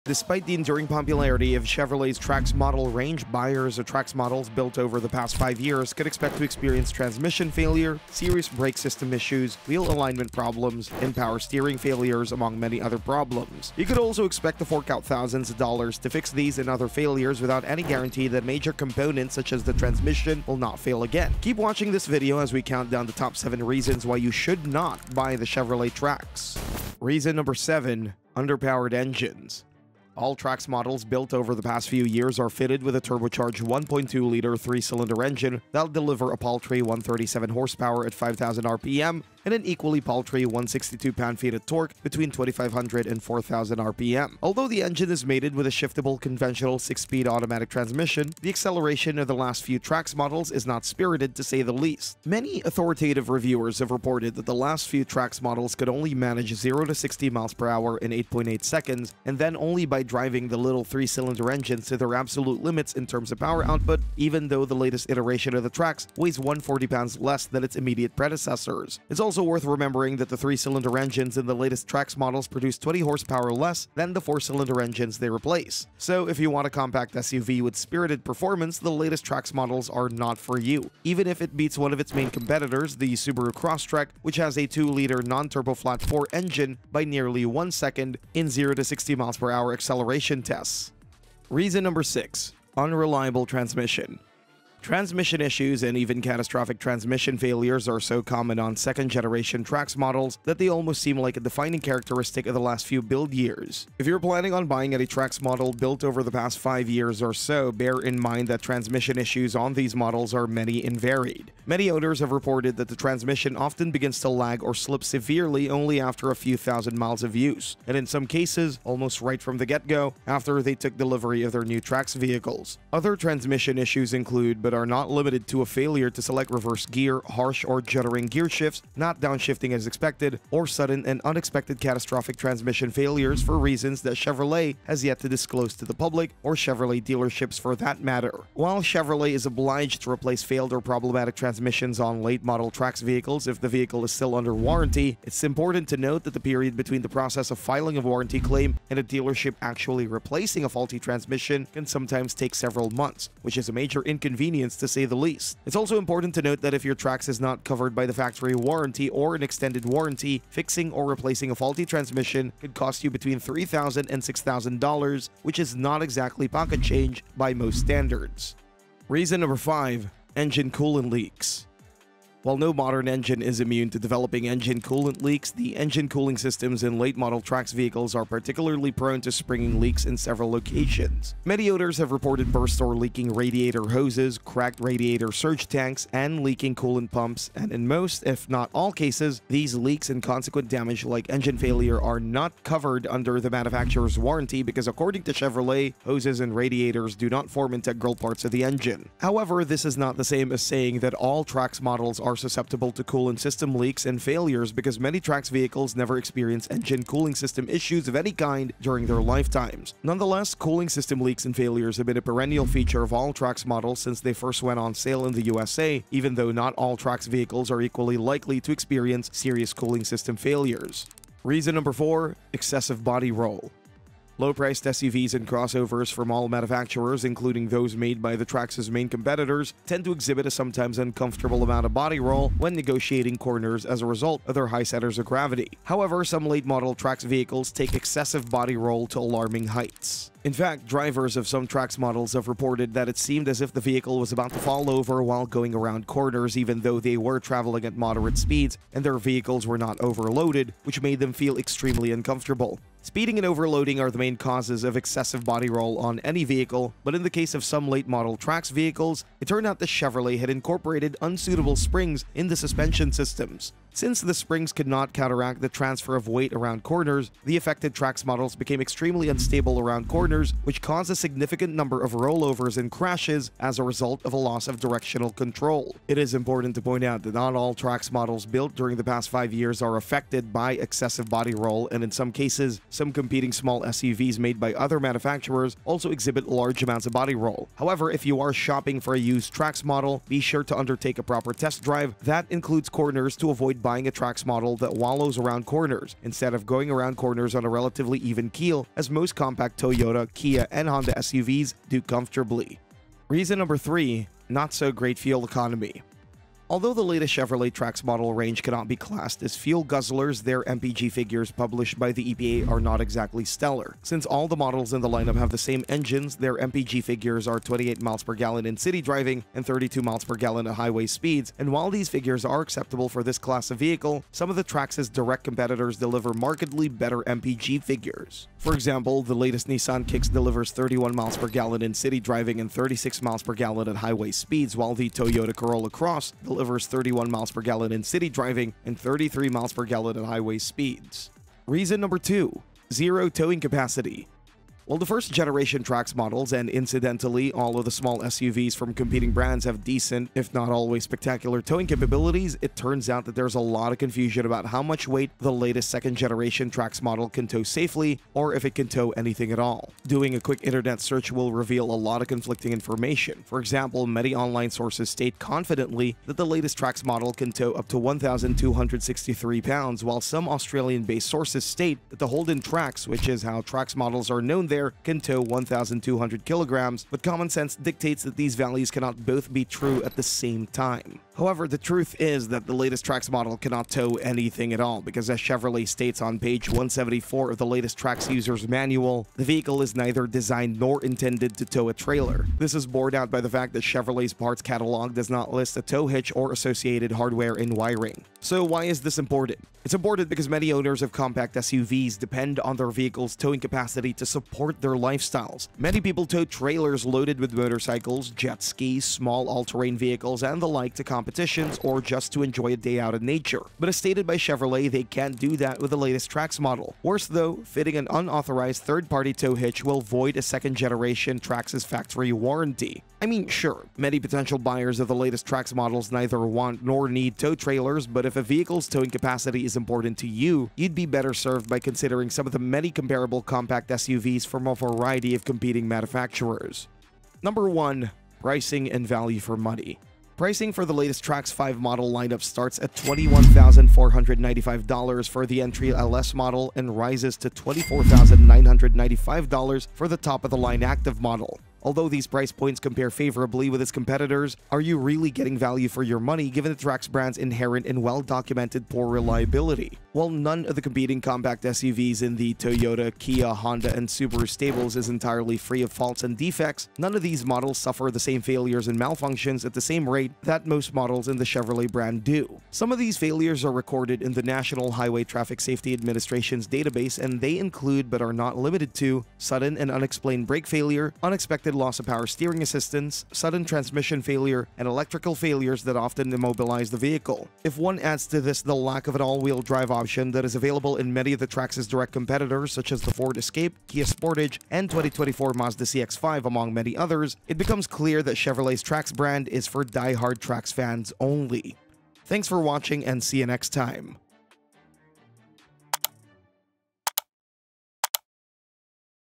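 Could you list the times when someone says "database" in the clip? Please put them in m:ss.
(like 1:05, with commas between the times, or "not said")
7:56.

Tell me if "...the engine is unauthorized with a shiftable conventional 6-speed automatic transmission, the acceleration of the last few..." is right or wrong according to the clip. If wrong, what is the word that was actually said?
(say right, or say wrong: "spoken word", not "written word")
wrong: "mated", not "unauthorized".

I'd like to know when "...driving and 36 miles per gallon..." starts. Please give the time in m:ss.
5:32.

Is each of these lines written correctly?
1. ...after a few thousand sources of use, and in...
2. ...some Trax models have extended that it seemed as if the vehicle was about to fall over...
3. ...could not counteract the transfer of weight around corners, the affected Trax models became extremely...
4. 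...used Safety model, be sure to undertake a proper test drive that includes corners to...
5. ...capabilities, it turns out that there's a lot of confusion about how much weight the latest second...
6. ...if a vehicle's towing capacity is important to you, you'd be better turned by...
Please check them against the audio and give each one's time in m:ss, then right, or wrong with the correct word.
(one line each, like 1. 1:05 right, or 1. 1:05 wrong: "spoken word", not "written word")
1. 1:56 wrong: "miles", not "sources"
2. 4:01 wrong: "reported", not "extended"
3. 4:24 right
4. 4:49 wrong: "Trax", not "Safety"
5. 5:51 right
6. 7:08 wrong: "served", not "turned".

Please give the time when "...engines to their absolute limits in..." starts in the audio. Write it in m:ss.
1:01.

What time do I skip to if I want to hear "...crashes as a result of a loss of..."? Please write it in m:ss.
4:32.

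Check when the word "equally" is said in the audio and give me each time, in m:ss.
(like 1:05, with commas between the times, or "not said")
0:39, 3:37.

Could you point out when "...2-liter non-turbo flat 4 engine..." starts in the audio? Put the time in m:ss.
1:24.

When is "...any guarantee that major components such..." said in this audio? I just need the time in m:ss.
0:17.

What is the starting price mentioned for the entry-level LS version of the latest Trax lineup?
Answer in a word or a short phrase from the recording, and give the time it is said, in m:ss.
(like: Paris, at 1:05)
$21,495, at 7:22.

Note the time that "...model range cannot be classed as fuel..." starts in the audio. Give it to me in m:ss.
5:08.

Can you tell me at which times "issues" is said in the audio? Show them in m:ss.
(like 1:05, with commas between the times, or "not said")
0:09, 1:35, 1:49, 2:03, 3:27.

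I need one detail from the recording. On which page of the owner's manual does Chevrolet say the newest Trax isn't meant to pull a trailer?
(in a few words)
174.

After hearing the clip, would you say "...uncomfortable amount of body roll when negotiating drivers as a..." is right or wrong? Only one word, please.
wrong.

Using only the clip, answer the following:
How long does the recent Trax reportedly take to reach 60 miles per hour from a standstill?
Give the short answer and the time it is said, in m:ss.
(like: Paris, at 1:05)
8.8 seconds, at 0:58.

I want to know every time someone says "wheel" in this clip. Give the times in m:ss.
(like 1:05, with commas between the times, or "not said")
0:09, 8:09.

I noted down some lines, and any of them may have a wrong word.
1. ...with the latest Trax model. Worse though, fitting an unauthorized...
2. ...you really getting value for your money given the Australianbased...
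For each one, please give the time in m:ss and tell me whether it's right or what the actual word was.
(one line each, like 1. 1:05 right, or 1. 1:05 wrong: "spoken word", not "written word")
1. 6:55 right
2. 7:34 wrong: "Trax", not "Australianbased".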